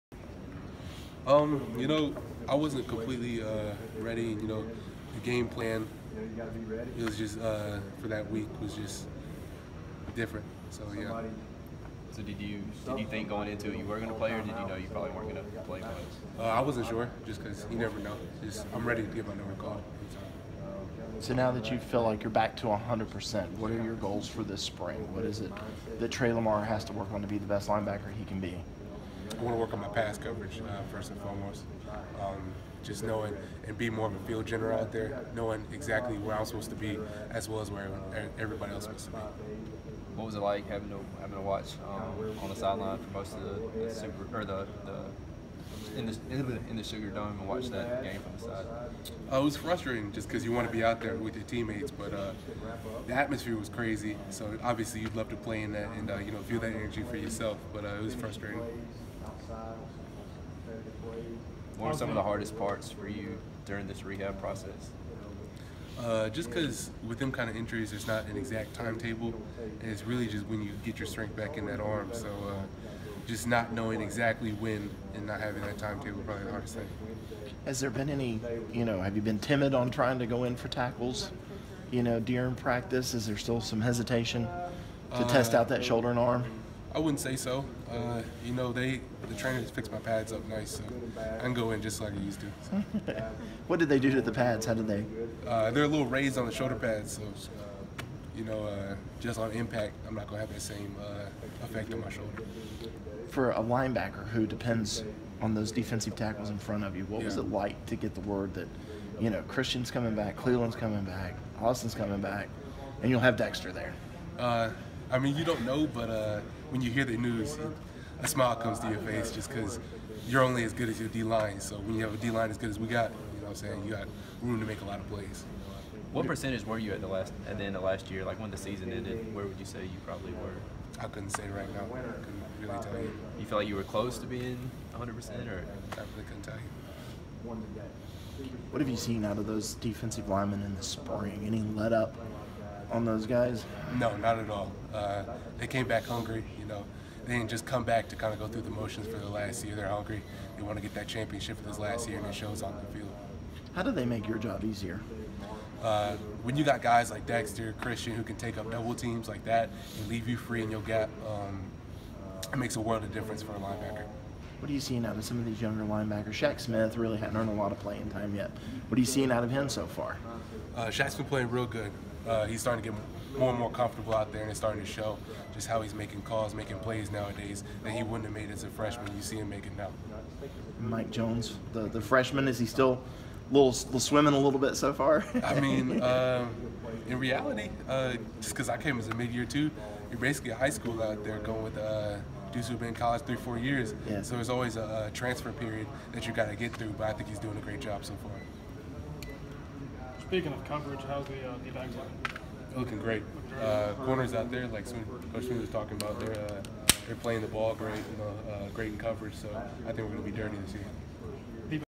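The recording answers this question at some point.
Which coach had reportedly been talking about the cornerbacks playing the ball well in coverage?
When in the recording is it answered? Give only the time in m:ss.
3:25.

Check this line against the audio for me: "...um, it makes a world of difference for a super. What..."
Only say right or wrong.
wrong.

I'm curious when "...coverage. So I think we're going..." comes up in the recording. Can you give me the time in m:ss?
3:28.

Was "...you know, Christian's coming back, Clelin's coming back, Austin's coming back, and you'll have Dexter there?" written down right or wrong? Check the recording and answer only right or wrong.
right.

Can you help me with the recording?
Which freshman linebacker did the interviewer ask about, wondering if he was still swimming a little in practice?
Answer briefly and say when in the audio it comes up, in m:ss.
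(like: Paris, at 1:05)
Mike Jones, at 3:00.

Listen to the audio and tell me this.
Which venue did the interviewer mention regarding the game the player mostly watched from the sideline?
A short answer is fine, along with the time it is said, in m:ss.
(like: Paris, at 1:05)
Sugar Dome, at 0:46.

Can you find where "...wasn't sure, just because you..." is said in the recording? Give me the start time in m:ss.
0:16.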